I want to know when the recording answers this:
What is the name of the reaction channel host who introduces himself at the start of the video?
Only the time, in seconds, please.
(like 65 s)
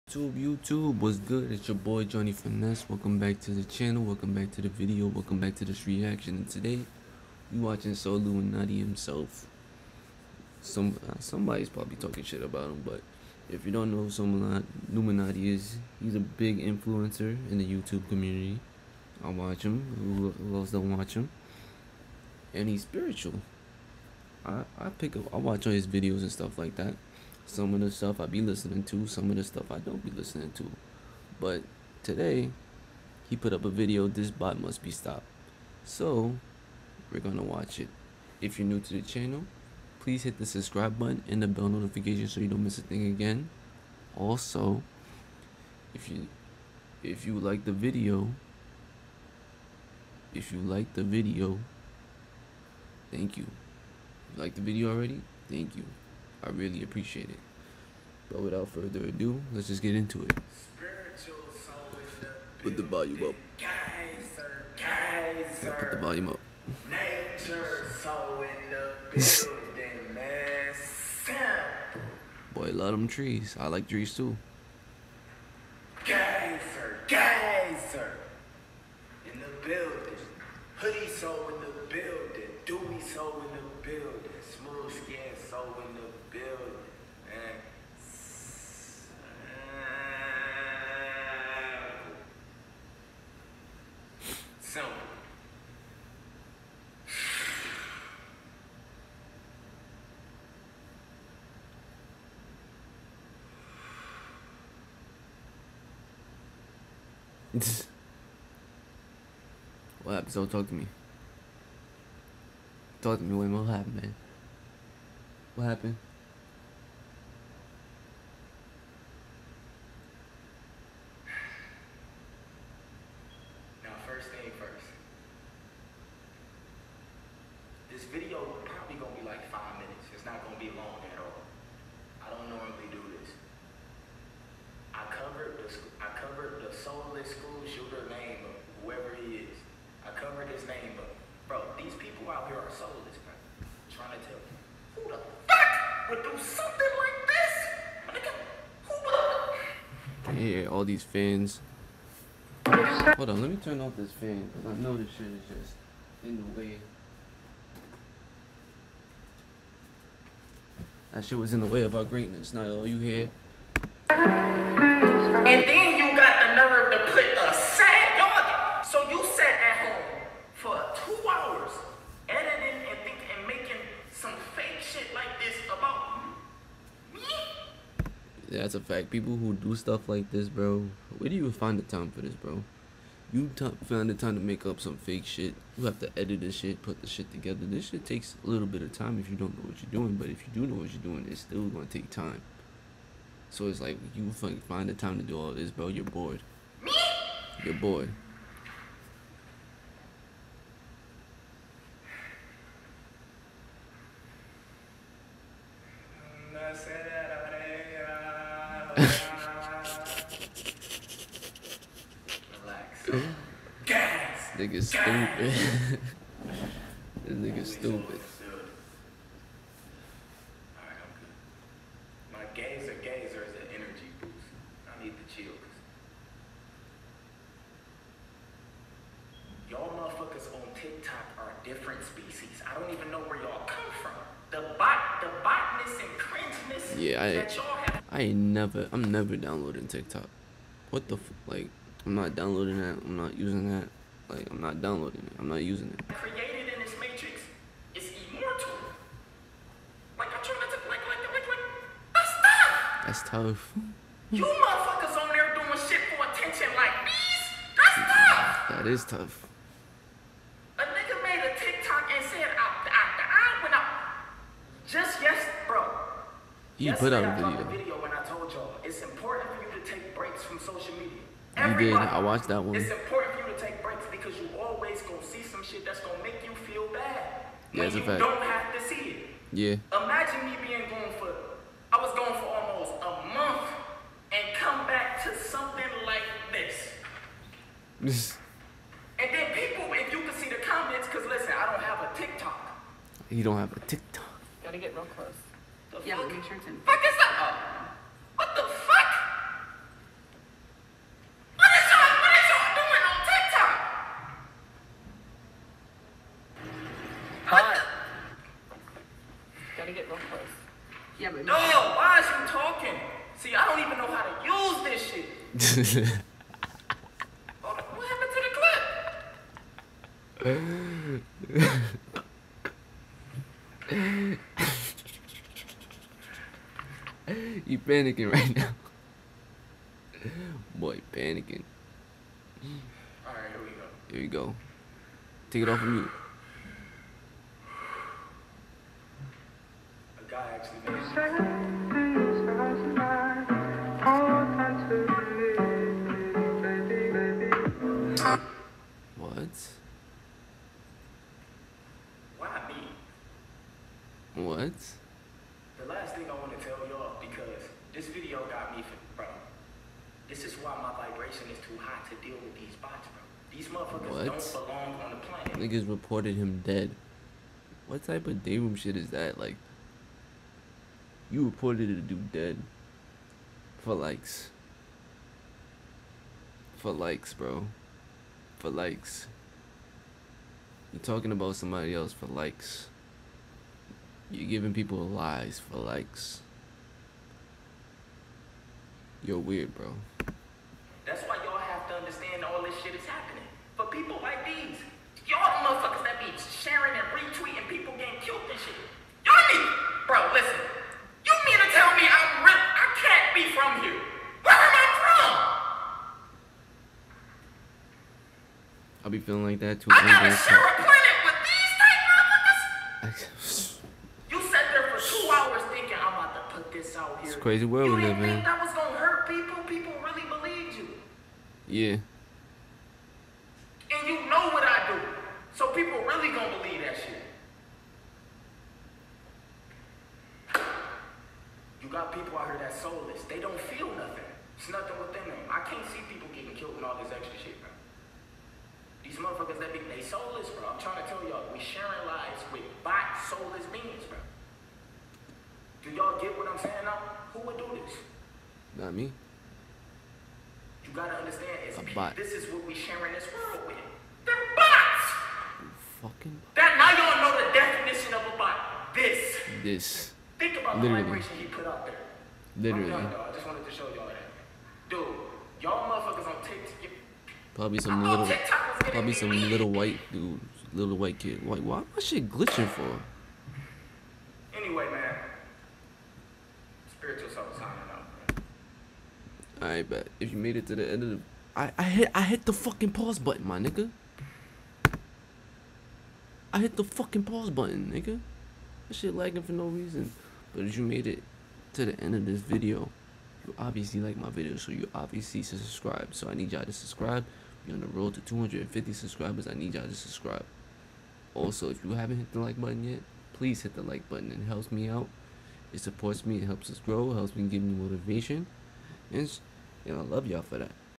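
2 s.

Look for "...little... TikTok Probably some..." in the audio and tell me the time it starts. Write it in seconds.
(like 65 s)
468 s.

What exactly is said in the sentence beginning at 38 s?
If you're new to the channel, please hit the subscribe button and the bell notification so you don't miss a thing again.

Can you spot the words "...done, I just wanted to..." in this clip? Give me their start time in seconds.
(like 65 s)
463 s.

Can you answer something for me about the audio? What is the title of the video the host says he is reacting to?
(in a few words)
This Bot Must Be Stopped.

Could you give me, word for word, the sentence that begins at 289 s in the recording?
and then people, if you can see the comments, because listen, I don't have a TikTok.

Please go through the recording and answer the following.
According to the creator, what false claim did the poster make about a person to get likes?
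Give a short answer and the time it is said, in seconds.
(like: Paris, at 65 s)
reported him dead, at 365 s.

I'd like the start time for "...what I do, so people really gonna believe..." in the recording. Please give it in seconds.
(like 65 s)
424 s.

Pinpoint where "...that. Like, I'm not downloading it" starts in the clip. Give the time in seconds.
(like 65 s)
243 s.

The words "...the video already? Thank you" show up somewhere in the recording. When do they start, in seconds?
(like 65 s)
54 s.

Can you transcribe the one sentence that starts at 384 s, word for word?
You're giving people lies for likes.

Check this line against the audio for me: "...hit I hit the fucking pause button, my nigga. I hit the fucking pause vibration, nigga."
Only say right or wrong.
wrong.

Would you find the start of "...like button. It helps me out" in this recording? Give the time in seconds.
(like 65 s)
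503 s.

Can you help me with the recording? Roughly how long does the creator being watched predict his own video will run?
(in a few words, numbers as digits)
5 minutes.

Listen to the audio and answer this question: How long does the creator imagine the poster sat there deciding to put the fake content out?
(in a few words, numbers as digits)
2 hours.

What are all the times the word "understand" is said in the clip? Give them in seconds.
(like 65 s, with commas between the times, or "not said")
391 s, 451 s.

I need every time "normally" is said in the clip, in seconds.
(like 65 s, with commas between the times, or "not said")
132 s.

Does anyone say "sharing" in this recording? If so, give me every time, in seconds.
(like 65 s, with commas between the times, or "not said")
396 s, 441 s, 452 s.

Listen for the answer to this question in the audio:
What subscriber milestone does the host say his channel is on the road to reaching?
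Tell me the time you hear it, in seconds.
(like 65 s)
498 s.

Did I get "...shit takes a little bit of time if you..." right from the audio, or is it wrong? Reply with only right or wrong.
right.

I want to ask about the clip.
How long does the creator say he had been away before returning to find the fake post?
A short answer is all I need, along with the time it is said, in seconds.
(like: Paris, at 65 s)
almost a month, at 282 s.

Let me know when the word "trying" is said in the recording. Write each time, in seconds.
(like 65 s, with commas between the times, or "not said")
143 s, 250 s, 440 s.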